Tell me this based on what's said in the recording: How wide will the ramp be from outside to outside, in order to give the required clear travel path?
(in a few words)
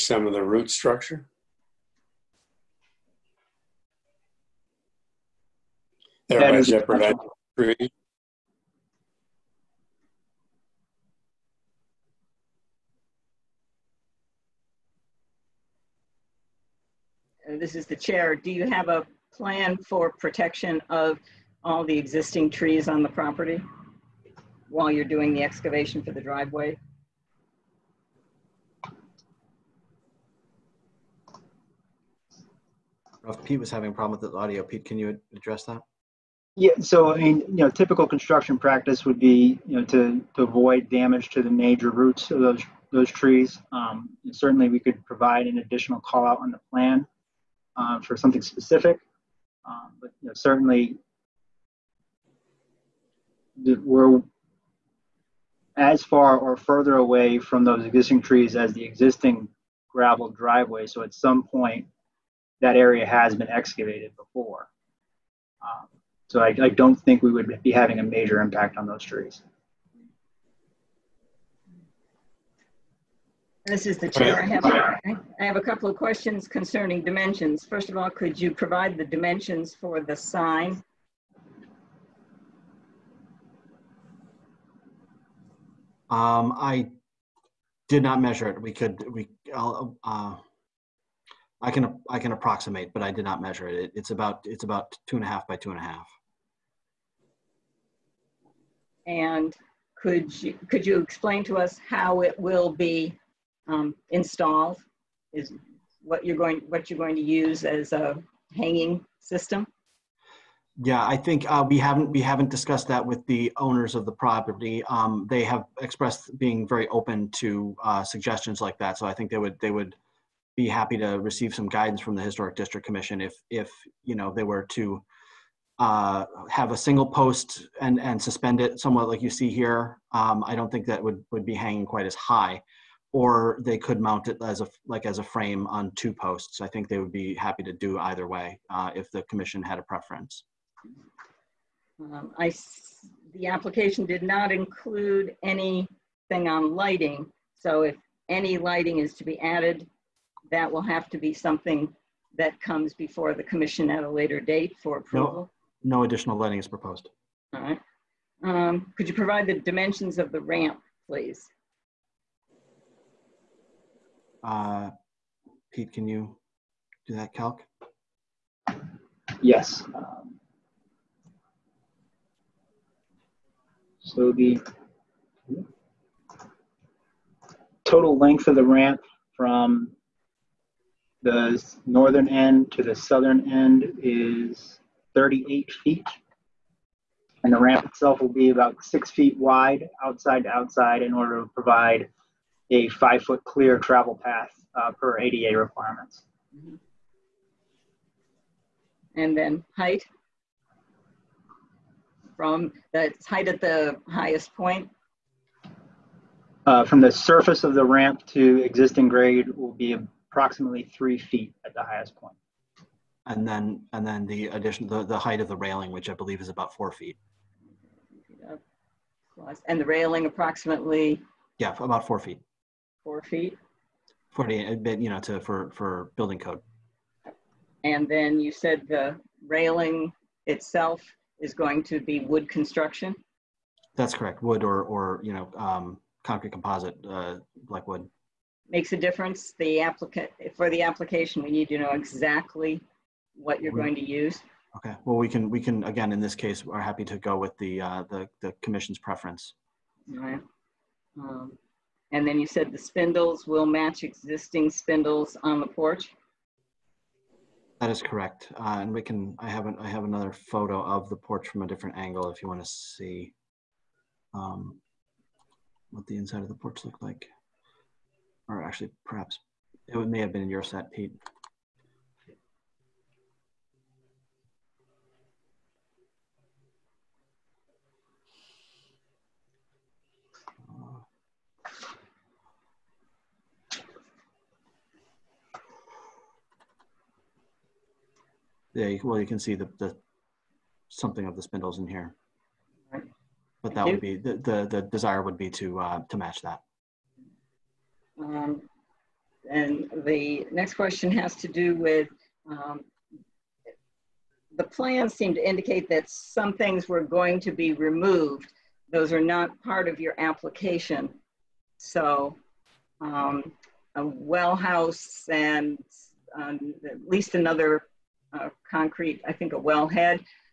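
6 feet.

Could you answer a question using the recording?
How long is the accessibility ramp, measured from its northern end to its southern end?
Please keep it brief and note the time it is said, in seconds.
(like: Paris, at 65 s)
38 feet, at 185 s.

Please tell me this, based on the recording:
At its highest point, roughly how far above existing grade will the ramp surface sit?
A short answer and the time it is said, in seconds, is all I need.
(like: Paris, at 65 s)
3 feet, at 210 s.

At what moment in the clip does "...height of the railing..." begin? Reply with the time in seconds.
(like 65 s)
215 s.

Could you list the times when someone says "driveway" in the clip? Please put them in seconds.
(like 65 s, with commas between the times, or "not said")
26 s, 60 s.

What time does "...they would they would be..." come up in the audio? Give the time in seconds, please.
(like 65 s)
119 s.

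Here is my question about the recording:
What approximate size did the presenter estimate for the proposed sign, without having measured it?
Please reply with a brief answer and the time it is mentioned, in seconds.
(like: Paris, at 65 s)
2.5 by 2.5, at 95 s.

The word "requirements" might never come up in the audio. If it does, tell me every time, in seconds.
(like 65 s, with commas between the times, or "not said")
195 s.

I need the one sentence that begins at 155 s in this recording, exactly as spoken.
No, no additional lighting is proposed.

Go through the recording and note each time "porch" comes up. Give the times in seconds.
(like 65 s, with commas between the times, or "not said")
255 s, 261 s, 266 s.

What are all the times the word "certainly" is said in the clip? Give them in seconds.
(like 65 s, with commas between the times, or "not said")
44 s, 50 s.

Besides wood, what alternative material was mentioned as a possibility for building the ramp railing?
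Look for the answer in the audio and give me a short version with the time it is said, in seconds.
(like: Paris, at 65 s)
concrete composite, at 236 s.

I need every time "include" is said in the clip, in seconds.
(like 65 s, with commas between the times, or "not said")
144 s.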